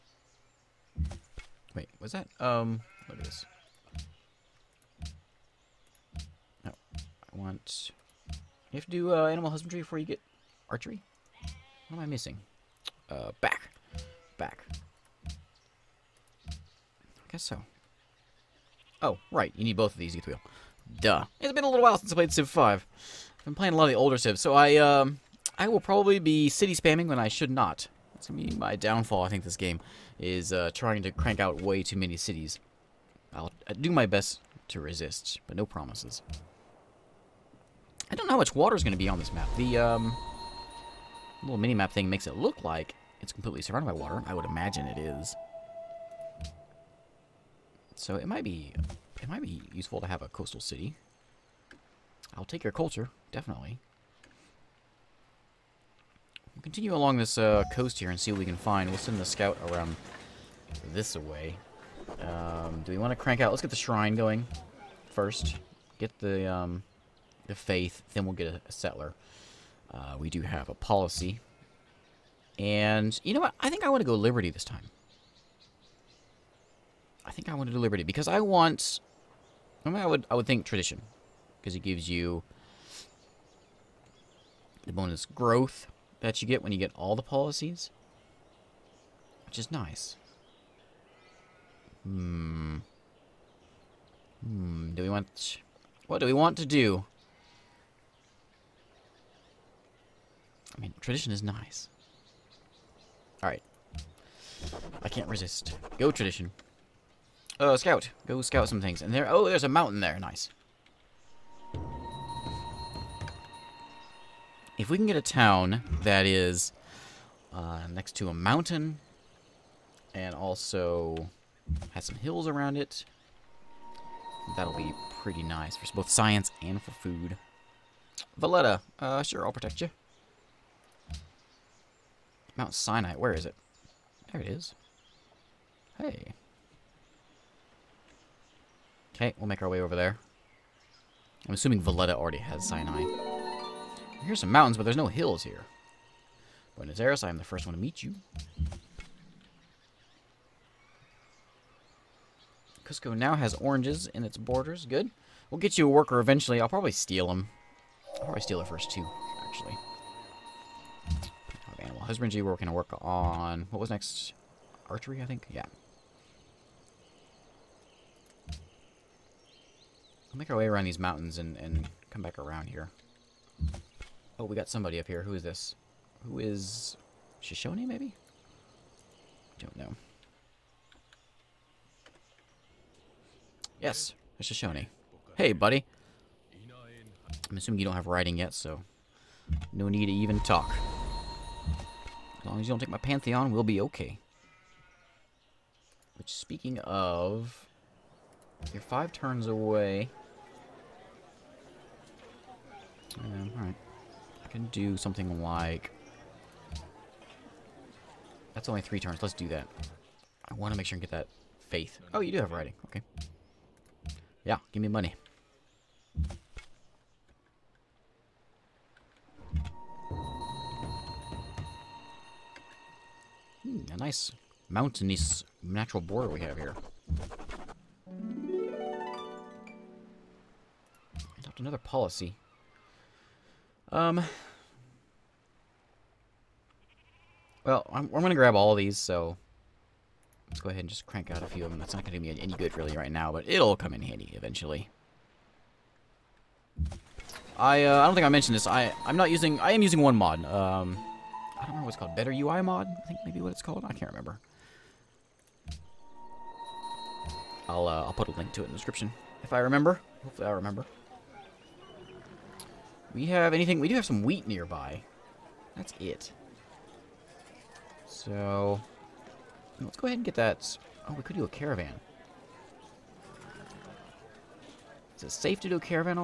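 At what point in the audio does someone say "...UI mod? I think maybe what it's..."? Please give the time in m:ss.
4:12.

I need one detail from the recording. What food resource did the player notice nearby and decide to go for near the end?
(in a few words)
Wheat.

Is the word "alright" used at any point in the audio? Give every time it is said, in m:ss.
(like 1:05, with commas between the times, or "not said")
1:43, 3:23.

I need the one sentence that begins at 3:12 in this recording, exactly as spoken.
As long as you don't take my Pantheon, we'll be okay.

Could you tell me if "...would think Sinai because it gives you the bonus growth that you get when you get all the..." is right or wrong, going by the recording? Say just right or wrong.
wrong.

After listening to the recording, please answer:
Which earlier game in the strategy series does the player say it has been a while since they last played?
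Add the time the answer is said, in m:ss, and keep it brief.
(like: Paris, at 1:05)
Civ 5, at 0:22.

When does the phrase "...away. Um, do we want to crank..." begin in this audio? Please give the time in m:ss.
1:01.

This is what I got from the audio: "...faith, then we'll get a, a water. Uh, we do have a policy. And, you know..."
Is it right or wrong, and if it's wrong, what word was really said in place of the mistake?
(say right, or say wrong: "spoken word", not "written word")
wrong: "settler", not "water".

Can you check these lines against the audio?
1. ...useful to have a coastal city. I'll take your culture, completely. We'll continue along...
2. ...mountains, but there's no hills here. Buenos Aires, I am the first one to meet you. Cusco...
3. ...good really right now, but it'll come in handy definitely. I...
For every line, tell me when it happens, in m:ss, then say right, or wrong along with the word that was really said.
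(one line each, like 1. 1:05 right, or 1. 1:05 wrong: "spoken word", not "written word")
1. 0:49 wrong: "definitely", not "completely"
2. 2:24 right
3. 4:02 wrong: "eventually", not "definitely".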